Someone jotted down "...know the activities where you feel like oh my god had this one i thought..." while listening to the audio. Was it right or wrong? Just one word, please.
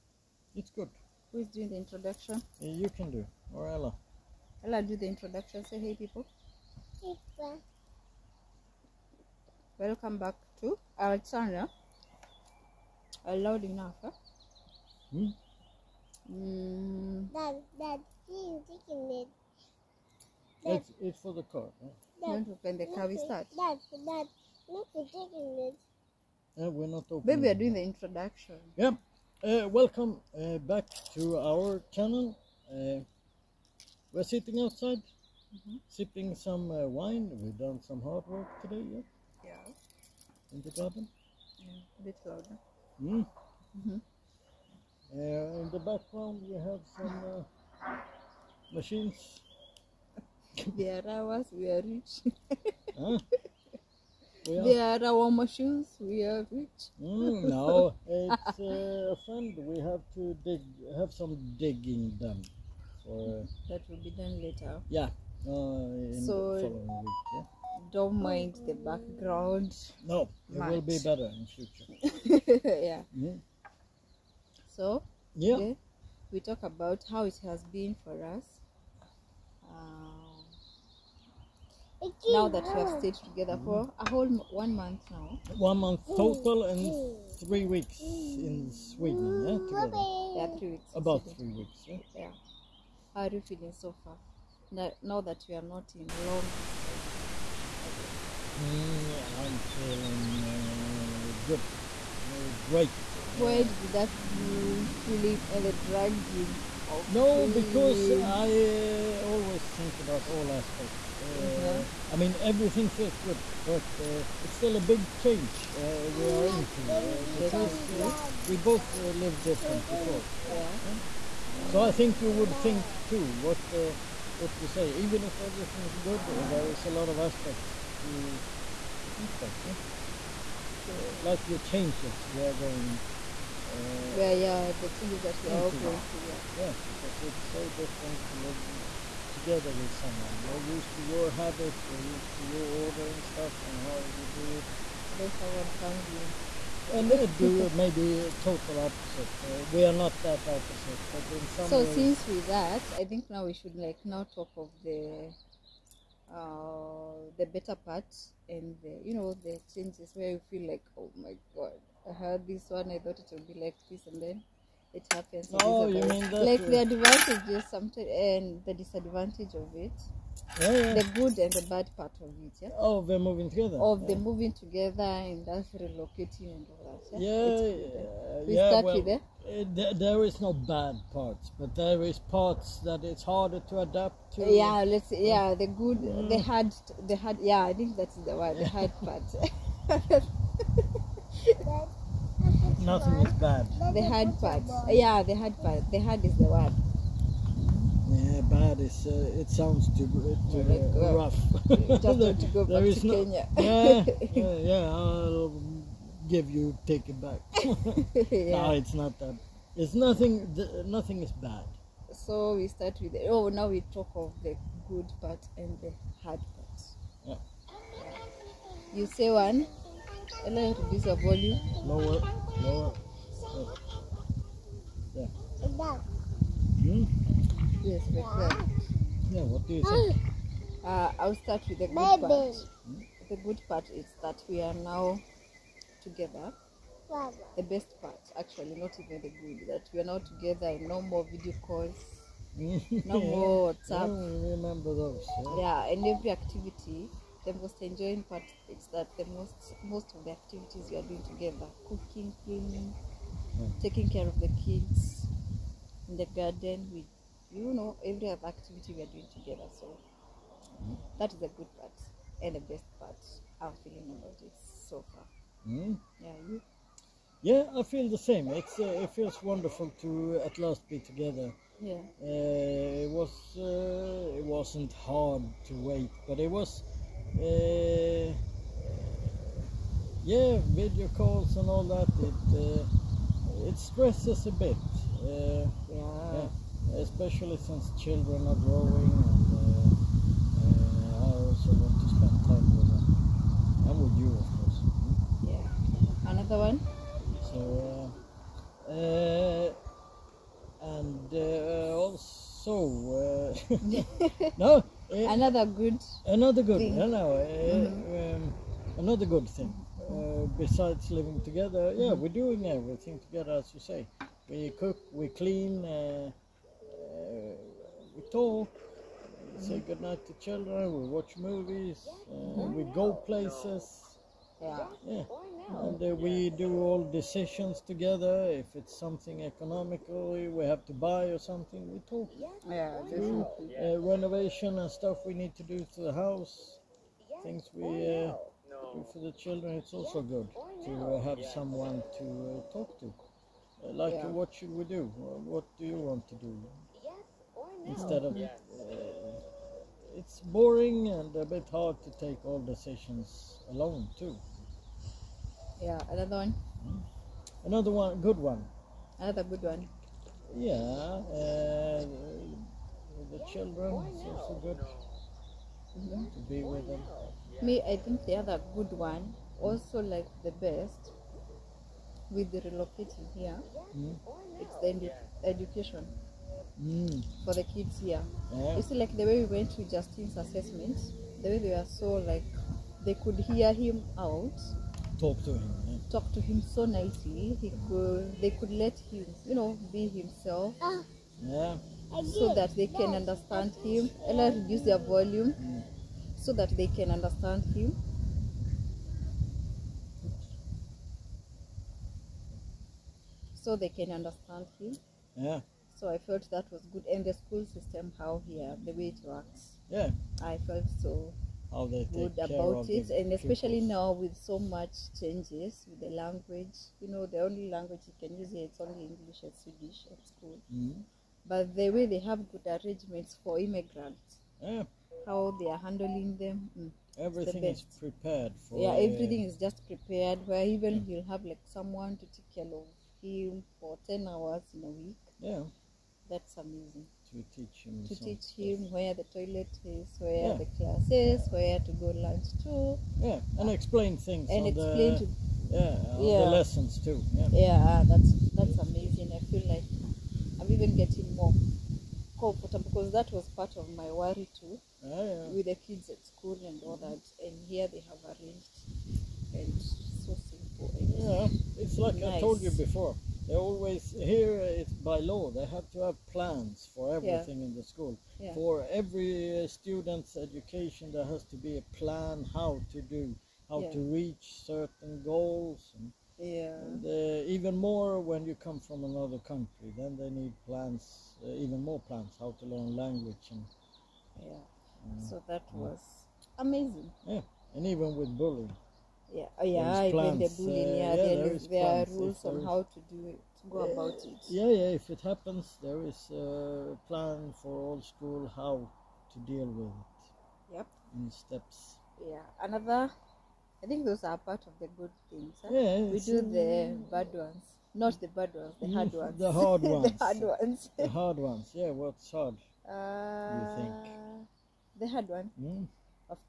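wrong.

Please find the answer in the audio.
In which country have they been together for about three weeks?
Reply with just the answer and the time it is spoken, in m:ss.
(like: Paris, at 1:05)
Sweden, at 1:27.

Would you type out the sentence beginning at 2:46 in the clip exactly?
the advantages sometimes and the disadvantage of it yeah, yeah.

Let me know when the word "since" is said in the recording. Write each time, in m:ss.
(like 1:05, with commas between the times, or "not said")
2:31, 4:47.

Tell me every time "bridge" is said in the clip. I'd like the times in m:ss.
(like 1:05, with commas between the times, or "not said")
not said.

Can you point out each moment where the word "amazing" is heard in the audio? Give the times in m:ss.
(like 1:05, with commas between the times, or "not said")
7:16, 7:28, 8:06.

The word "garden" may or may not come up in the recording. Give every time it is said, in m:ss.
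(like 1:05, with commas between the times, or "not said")
0:40, 4:16.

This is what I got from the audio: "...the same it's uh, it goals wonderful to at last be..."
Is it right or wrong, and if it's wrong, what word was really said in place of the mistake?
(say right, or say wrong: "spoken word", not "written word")
wrong: "feels", not "goals".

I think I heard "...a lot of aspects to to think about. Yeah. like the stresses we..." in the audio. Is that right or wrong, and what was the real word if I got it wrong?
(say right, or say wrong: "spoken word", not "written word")
wrong: "changes", not "stresses".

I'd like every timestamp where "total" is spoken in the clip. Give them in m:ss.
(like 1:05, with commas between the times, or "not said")
1:26, 2:28.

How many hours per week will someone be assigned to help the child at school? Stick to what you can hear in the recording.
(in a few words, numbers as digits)
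10 hours.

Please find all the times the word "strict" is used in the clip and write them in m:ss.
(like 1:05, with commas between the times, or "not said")
not said.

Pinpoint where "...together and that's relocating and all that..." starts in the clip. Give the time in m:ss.
2:54.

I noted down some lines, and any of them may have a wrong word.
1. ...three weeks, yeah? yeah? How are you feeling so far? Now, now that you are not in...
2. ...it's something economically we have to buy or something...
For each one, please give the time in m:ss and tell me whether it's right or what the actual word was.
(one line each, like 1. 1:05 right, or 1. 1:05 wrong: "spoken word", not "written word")
1. 1:31 right
2. 5:28 right.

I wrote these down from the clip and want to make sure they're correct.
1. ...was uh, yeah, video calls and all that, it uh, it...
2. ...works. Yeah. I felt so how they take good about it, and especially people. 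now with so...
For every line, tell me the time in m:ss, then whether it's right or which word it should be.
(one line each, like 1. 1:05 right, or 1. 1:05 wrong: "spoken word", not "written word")
1. 4:36 right
2. 6:49 right.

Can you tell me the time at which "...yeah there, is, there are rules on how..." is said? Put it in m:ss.
8:11.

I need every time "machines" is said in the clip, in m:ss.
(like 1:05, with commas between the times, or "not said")
0:48, 0:55.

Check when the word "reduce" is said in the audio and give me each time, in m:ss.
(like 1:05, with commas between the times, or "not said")
3:40, 6:34.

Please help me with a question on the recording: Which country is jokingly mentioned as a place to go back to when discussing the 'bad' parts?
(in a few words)
Kenya.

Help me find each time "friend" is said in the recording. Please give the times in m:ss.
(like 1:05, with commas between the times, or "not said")
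0:59, 3:48.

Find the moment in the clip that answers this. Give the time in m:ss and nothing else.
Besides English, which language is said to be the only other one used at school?
6:59.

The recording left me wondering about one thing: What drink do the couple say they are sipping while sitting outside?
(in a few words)
Wine.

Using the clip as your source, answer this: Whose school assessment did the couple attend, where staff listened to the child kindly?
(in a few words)
Justin.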